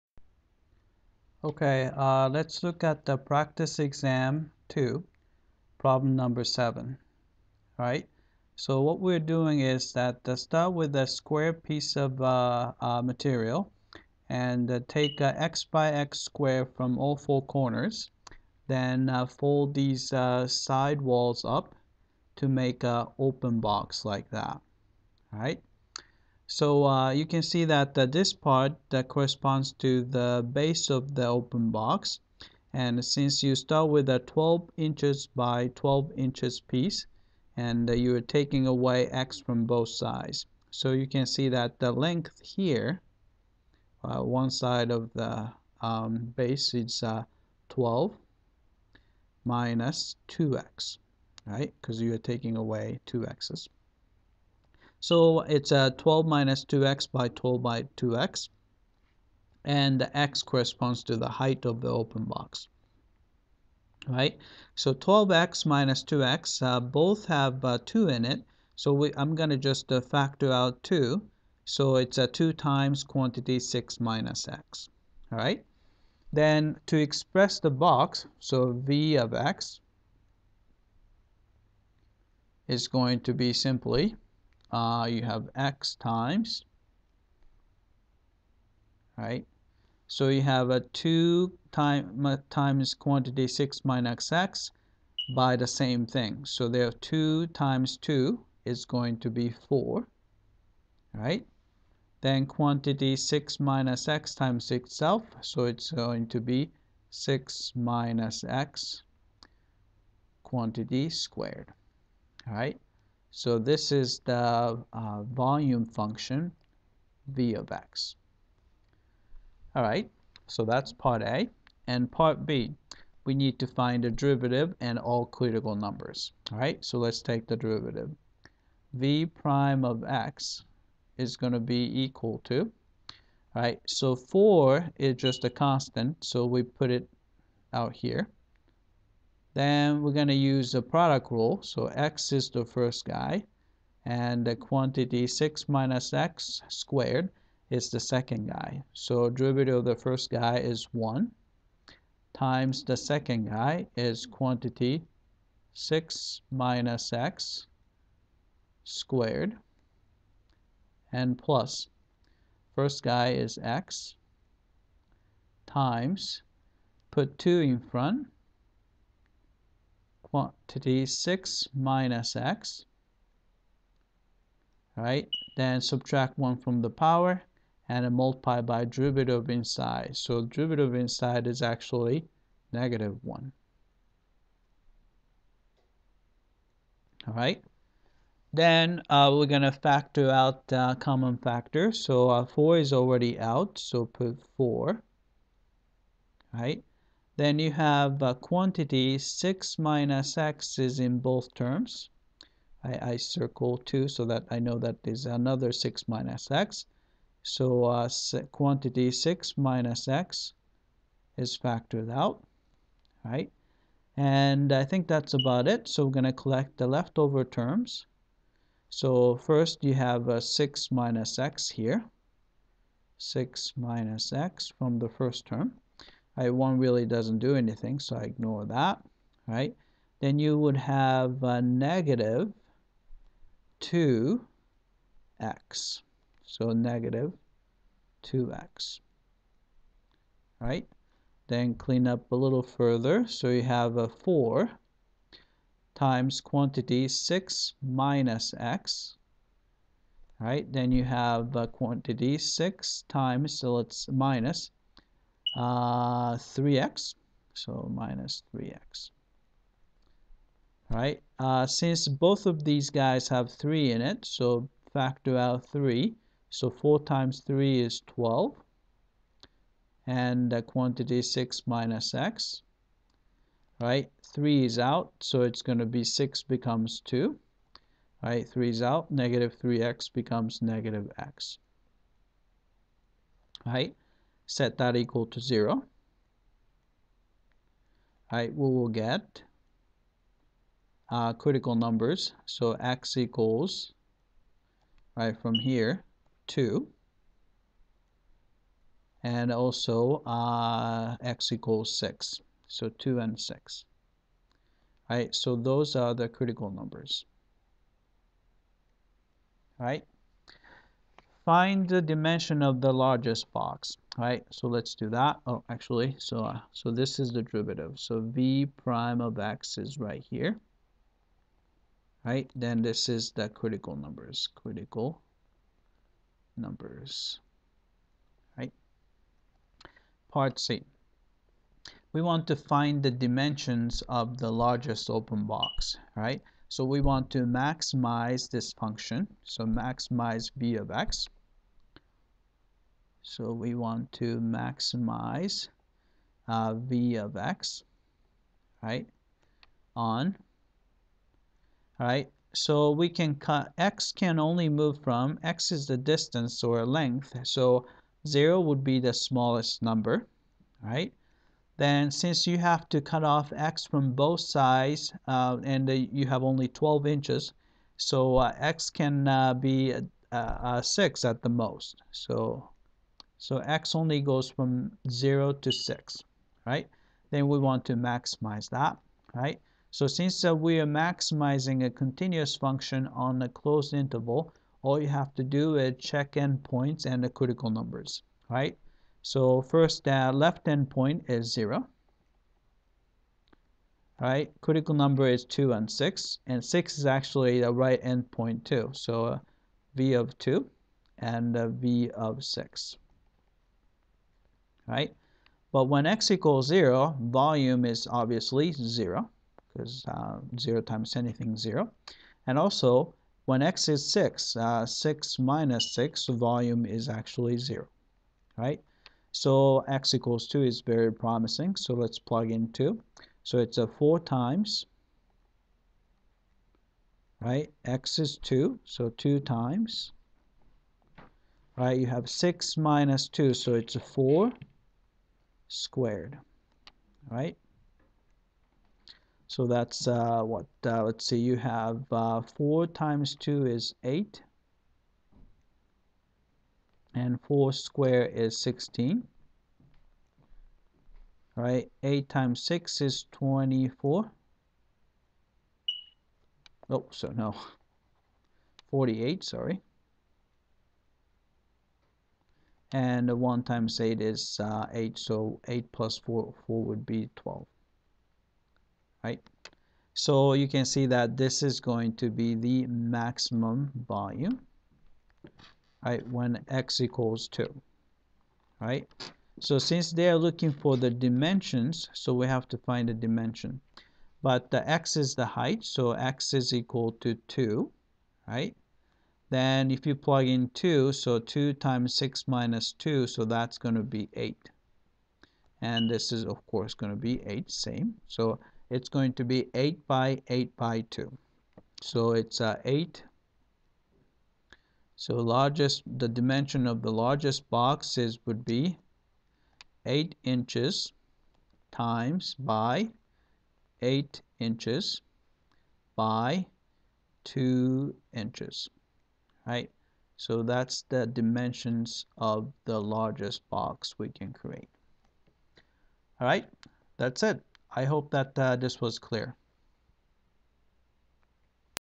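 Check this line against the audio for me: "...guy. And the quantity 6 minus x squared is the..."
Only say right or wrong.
right.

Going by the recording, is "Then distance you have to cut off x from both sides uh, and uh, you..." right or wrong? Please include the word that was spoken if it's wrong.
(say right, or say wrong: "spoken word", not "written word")
wrong: "since", not "distance".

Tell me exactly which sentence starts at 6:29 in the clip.
So first, uh, left endpoint is 0, right?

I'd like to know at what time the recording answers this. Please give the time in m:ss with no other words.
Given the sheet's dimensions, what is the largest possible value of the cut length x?
6:10.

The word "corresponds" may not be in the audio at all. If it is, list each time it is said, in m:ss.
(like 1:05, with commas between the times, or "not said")
0:29, 1:00.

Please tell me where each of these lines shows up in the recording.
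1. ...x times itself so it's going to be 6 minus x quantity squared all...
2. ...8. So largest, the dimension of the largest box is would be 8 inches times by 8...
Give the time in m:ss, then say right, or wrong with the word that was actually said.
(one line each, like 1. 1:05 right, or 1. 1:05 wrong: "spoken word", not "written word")
1. 1:44 right
2. 8:22 right.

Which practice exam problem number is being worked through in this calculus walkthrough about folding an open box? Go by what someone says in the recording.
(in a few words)
7.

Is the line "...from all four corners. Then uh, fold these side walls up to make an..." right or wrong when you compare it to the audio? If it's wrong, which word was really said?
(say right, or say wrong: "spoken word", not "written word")
right.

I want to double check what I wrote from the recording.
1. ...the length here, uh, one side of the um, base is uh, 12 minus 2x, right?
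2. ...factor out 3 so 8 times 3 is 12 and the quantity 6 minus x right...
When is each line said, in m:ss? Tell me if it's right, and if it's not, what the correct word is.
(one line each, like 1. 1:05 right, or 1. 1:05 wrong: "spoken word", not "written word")
1. 0:41 right
2. 4:24 wrong: "4", not "8".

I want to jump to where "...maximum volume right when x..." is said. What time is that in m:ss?
7:52.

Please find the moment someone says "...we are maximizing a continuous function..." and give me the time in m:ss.
6:20.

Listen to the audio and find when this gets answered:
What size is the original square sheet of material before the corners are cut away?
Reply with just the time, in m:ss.
0:34.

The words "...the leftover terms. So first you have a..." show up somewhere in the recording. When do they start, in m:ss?
3:36.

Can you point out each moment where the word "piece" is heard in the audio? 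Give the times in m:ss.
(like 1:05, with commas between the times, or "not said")
0:11, 0:36.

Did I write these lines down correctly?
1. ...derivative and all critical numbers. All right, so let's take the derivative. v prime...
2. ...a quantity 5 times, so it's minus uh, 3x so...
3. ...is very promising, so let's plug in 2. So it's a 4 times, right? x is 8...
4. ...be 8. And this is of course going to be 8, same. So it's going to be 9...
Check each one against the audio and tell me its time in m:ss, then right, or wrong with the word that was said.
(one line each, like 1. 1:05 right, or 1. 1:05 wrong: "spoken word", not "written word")
1. 2:04 right
2. 4:11 wrong: "6", not "5"
3. 7:00 wrong: "2", not "8"
4. 8:14 wrong: "8", not "9".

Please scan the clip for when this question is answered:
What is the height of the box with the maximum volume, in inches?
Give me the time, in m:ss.
8:37.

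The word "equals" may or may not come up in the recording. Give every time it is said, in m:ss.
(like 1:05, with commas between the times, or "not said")
2:12, 4:44, 4:53, 5:01, 6:46, 7:00, 7:56, 8:06.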